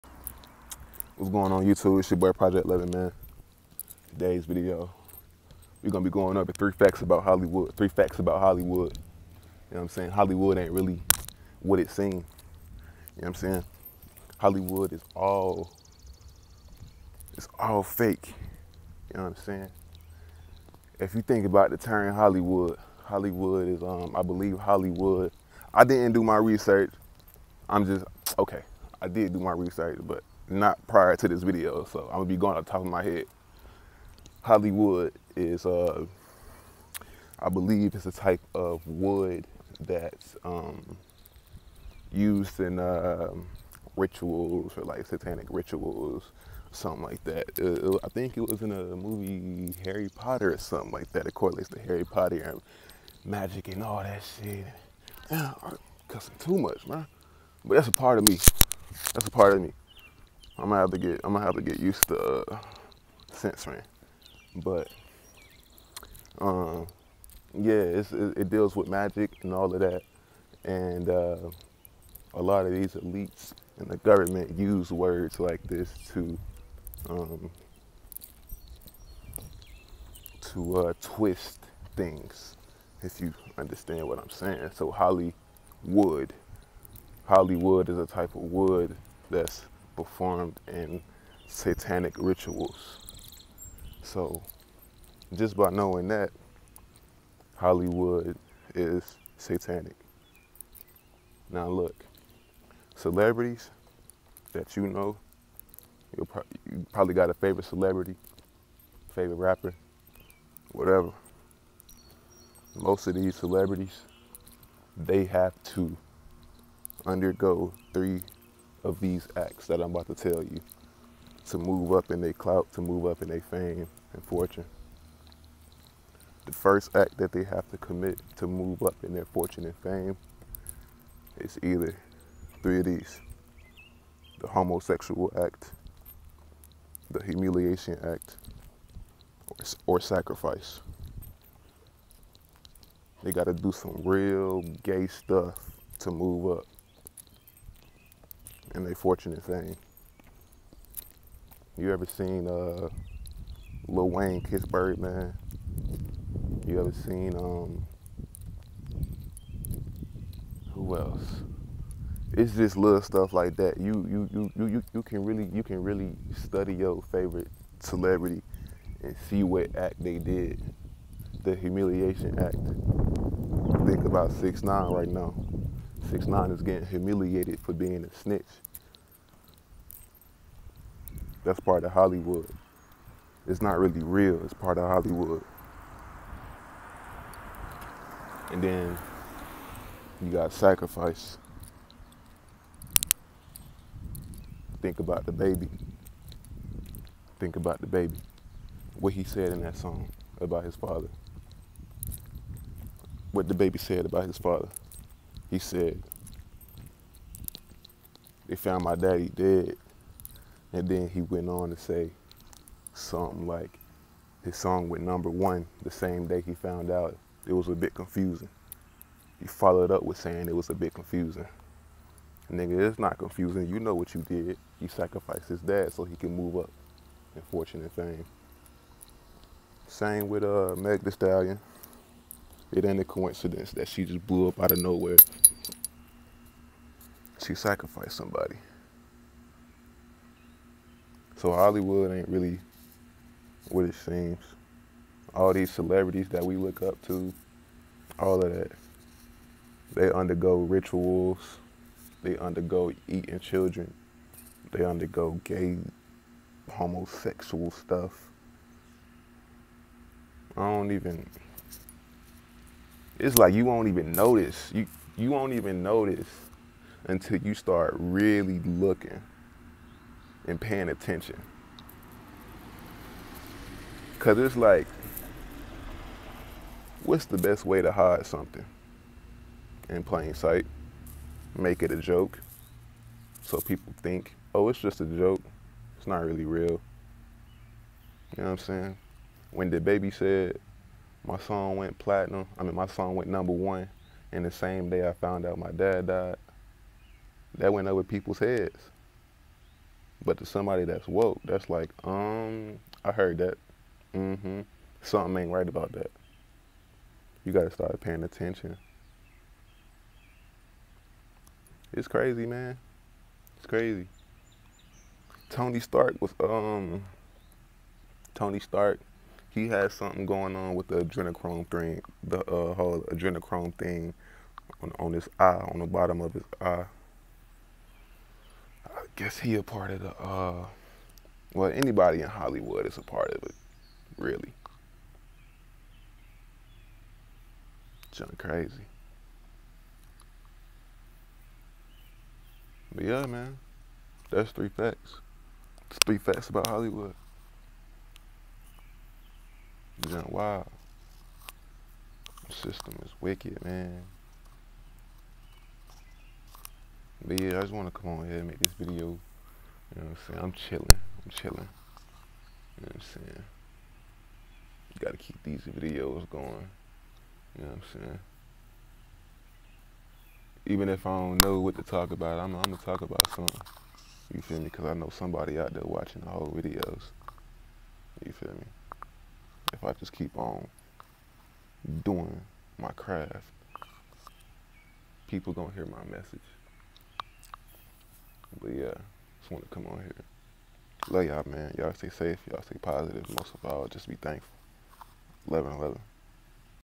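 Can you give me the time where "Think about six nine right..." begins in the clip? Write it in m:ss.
2:53.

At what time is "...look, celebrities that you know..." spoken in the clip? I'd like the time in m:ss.
1:41.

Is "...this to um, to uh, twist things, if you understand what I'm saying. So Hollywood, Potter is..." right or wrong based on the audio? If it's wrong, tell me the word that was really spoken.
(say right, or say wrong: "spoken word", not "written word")
wrong: "Hollywood", not "Potter".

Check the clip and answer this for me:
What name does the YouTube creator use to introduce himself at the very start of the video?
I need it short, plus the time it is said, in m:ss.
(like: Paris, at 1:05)
Project 11, at 0:02.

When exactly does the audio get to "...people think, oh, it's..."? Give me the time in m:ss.
4:43.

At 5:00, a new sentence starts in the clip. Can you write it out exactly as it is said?
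But to somebody that's woke, that's like, um, I heard that.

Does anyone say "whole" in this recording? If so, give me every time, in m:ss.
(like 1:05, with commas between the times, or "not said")
5:22, 6:16.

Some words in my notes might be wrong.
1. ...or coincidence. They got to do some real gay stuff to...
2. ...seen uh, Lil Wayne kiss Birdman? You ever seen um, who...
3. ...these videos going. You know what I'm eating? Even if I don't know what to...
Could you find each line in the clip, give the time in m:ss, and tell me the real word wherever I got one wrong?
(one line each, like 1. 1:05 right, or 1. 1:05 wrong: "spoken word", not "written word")
1. 2:19 wrong: "sacrifice", not "coincidence"
2. 2:32 right
3. 6:05 wrong: "saying", not "eating".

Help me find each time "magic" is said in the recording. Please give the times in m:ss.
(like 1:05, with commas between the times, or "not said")
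0:53, 1:08.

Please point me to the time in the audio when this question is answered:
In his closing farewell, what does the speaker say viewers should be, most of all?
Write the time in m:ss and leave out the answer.
6:34.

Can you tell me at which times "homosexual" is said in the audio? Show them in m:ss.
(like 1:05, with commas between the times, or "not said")
2:14, 4:16.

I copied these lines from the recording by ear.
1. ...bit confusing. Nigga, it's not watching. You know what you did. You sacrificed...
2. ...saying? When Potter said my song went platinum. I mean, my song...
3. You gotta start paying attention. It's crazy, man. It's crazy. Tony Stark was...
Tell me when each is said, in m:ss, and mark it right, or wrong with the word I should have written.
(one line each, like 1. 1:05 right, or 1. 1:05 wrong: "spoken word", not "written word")
1. 3:40 wrong: "confusing", not "watching"
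2. 4:48 wrong: "DaBaby", not "Potter"
3. 5:07 right.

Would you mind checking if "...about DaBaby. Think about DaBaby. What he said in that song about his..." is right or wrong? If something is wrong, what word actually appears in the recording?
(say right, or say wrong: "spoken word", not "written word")
right.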